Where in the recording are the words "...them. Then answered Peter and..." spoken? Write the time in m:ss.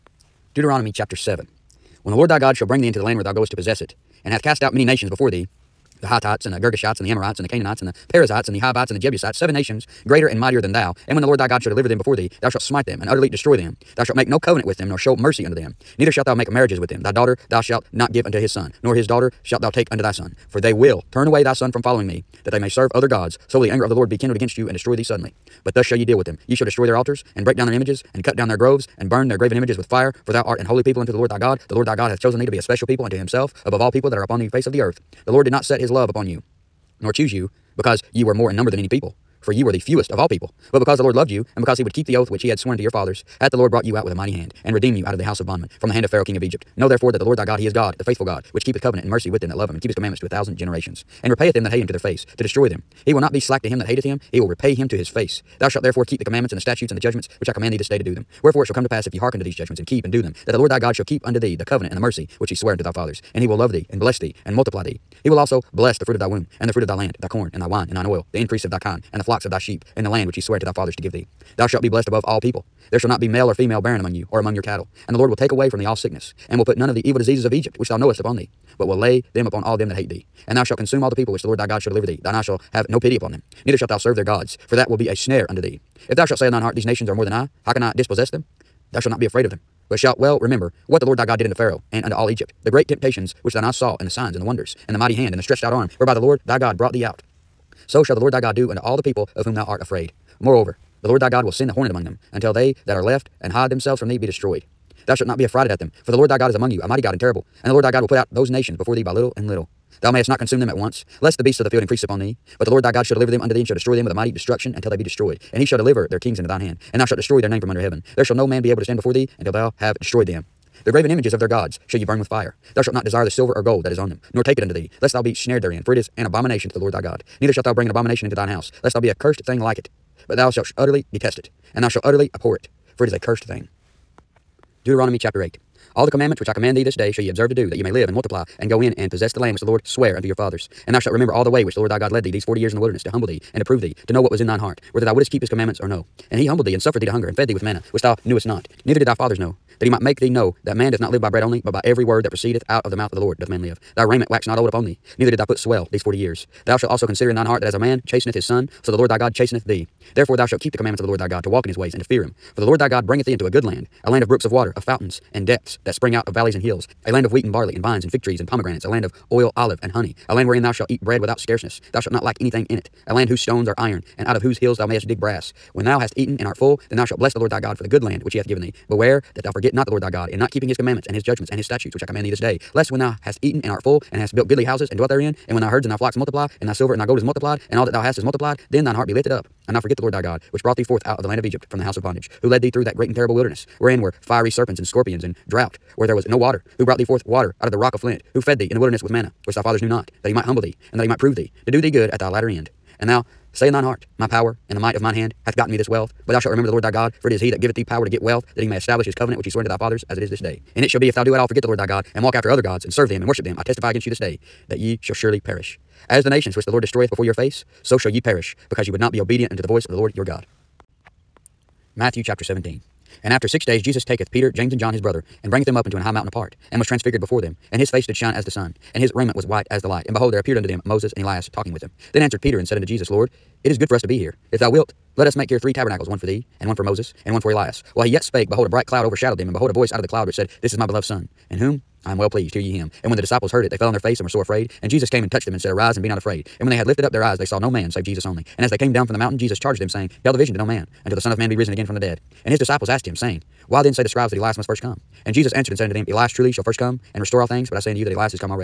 3:51.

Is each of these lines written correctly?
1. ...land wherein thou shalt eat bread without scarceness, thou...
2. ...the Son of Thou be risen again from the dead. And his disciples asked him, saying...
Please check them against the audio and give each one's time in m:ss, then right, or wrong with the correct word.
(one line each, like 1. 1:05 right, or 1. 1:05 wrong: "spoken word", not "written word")
1. 2:50 right
2. 4:11 wrong: "Man", not "Thou".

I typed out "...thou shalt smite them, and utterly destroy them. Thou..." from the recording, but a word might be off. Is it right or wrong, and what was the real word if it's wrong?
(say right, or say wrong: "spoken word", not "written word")
right.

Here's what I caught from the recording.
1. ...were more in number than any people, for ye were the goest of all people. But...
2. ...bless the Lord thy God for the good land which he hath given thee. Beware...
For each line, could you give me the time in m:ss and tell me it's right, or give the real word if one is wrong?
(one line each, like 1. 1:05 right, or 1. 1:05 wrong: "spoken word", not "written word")
1. 0:38 wrong: "fewest", not "goest"
2. 2:57 right.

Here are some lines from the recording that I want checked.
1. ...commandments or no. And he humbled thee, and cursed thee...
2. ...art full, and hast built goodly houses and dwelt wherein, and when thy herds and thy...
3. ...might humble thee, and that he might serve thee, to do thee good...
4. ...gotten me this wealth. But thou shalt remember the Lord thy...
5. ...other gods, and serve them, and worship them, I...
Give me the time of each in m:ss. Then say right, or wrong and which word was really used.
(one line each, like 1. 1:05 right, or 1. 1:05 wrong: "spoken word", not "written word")
1. 2:25 wrong: "suffered", not "cursed"
2. 3:03 wrong: "therein", not "wherein"
3. 3:20 wrong: "prove", not "serve"
4. 3:25 right
5. 3:32 right.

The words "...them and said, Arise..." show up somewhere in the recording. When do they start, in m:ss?
4:05.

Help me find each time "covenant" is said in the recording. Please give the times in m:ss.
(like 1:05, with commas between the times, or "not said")
0:14, 0:48, 1:01, 3:29.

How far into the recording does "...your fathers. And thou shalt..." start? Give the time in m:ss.
2:20.